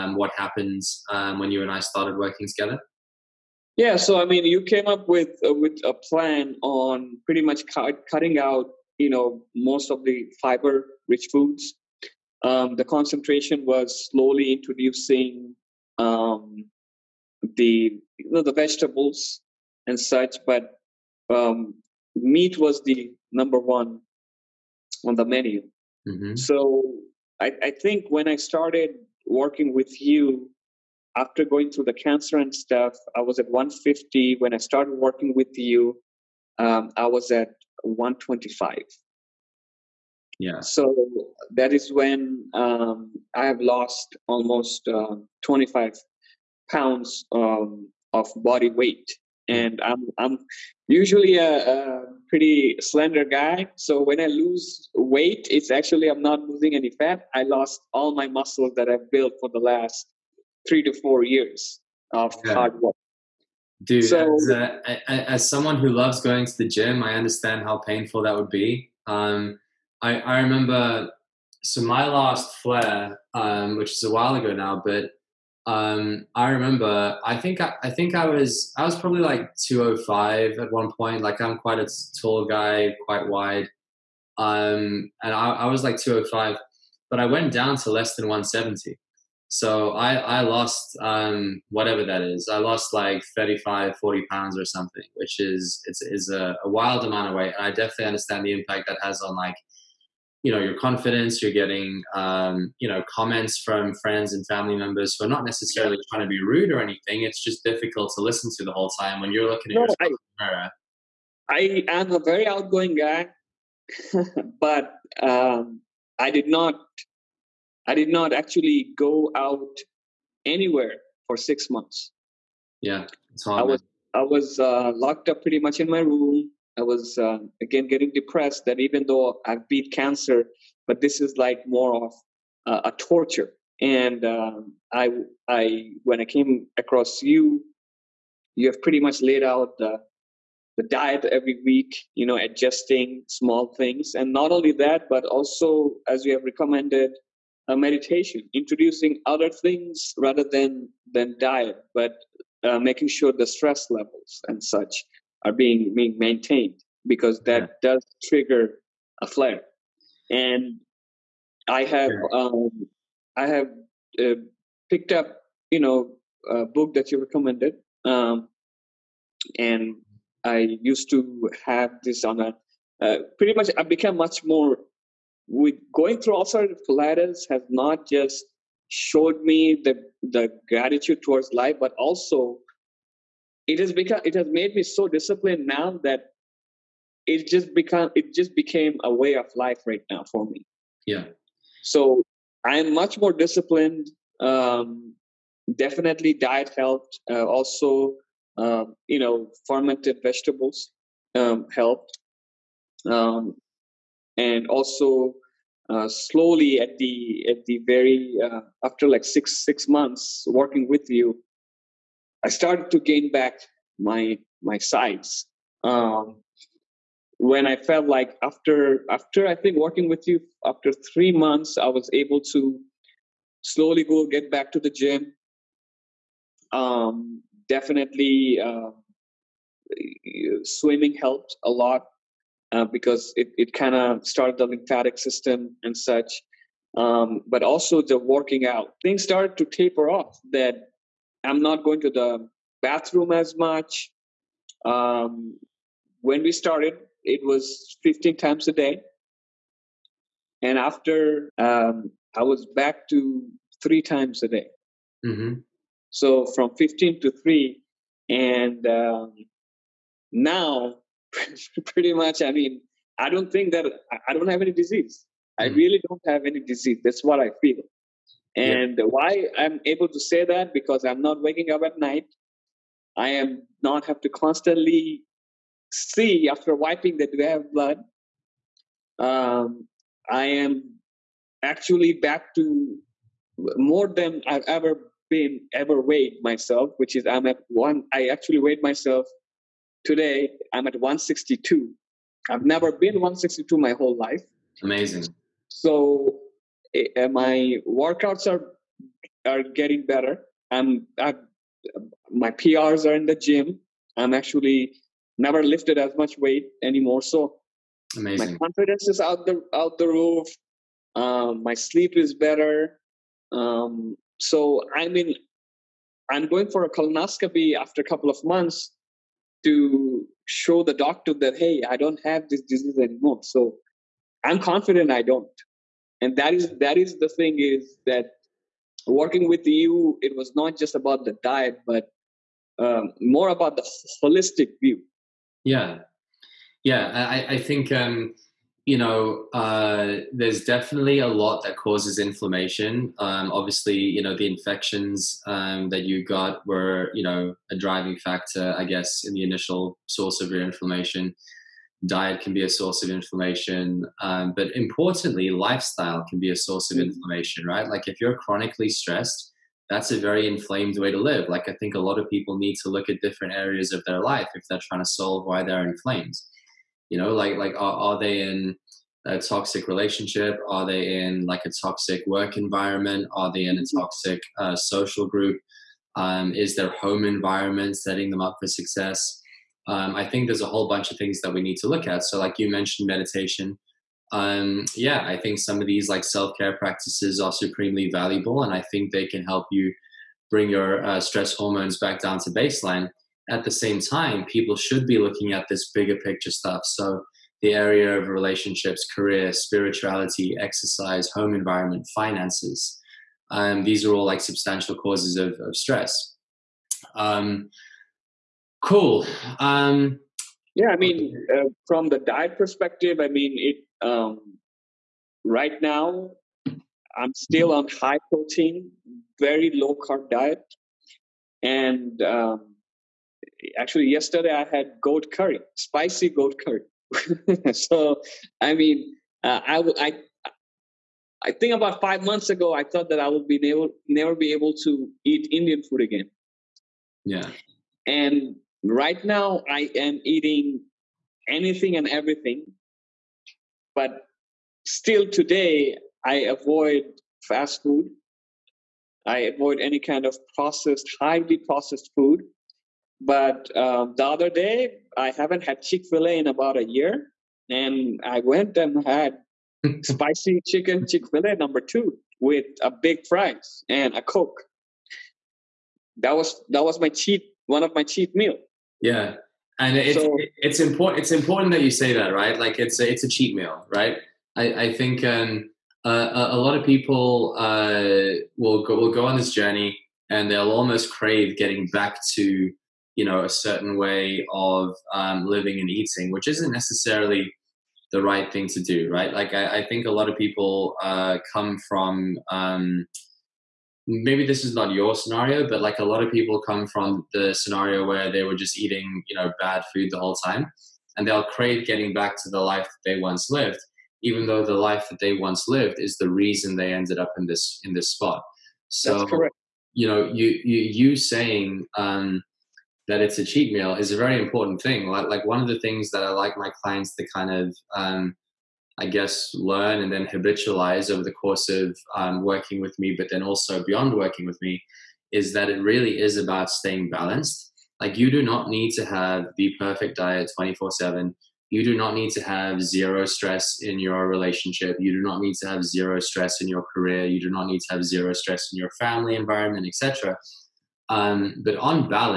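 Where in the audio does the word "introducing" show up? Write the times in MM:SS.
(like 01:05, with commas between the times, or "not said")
00:14, 02:28.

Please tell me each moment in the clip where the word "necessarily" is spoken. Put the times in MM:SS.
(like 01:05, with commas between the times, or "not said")
01:45, 08:06.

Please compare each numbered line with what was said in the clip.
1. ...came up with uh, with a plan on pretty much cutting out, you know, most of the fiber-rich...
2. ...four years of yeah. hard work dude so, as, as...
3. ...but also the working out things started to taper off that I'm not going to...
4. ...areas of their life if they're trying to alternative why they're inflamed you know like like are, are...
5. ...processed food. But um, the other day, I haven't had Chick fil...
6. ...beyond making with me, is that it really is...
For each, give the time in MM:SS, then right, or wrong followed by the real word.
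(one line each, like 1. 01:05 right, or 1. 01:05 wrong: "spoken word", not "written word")
1. 00:04 right
2. 01:01 right
3. 03:57 right
4. 06:03 wrong: "solve", not "alternative"
5. 07:31 right
6. 08:43 wrong: "working", not "making".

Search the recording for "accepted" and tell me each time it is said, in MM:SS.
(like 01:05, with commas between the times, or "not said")
not said.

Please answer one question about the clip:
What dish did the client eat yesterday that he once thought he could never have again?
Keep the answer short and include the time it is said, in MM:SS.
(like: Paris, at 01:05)
Spicy goat curry, at 07:05.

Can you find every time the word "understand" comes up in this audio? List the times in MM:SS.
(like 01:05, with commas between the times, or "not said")
01:07, 01:38.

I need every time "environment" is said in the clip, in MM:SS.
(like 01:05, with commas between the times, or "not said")
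06:12, 06:17, 06:41, 08:59.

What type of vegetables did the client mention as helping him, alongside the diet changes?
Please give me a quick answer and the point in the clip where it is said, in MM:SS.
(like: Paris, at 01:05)
Fermented vegetables, at 03:19.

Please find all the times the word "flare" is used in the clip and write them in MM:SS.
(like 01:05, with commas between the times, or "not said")
01:12, 02:39.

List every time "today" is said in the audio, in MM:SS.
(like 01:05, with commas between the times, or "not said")
04:50, 07:25.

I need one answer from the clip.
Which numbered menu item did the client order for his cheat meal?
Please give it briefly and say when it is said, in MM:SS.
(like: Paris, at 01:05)
Number two, at 07:41.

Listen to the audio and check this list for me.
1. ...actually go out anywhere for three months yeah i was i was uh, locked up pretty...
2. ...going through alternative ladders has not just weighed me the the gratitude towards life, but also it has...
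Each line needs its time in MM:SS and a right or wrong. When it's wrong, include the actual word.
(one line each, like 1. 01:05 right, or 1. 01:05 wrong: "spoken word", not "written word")
1. 01:58 wrong: "six", not "three"
2. 02:55 wrong: "showed", not "weighed".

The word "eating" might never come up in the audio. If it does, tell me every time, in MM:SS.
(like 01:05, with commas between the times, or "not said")
07:20, 08:05, 08:18.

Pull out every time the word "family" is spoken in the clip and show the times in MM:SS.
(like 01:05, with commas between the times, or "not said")
01:44, 08:59.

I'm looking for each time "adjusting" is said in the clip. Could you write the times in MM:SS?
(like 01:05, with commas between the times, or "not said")
02:22.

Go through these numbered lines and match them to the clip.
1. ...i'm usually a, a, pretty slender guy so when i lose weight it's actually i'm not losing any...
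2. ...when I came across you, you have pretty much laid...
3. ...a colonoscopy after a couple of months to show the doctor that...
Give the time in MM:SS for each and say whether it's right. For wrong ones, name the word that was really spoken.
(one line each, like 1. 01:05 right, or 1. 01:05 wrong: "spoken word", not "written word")
1. 00:50 right
2. 02:16 right
3. 05:16 right.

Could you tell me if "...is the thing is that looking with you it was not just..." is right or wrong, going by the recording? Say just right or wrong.
wrong.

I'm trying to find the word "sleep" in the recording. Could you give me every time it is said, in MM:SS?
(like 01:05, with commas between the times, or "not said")
05:11.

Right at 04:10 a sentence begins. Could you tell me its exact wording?
And after, um, I was back to three times a day.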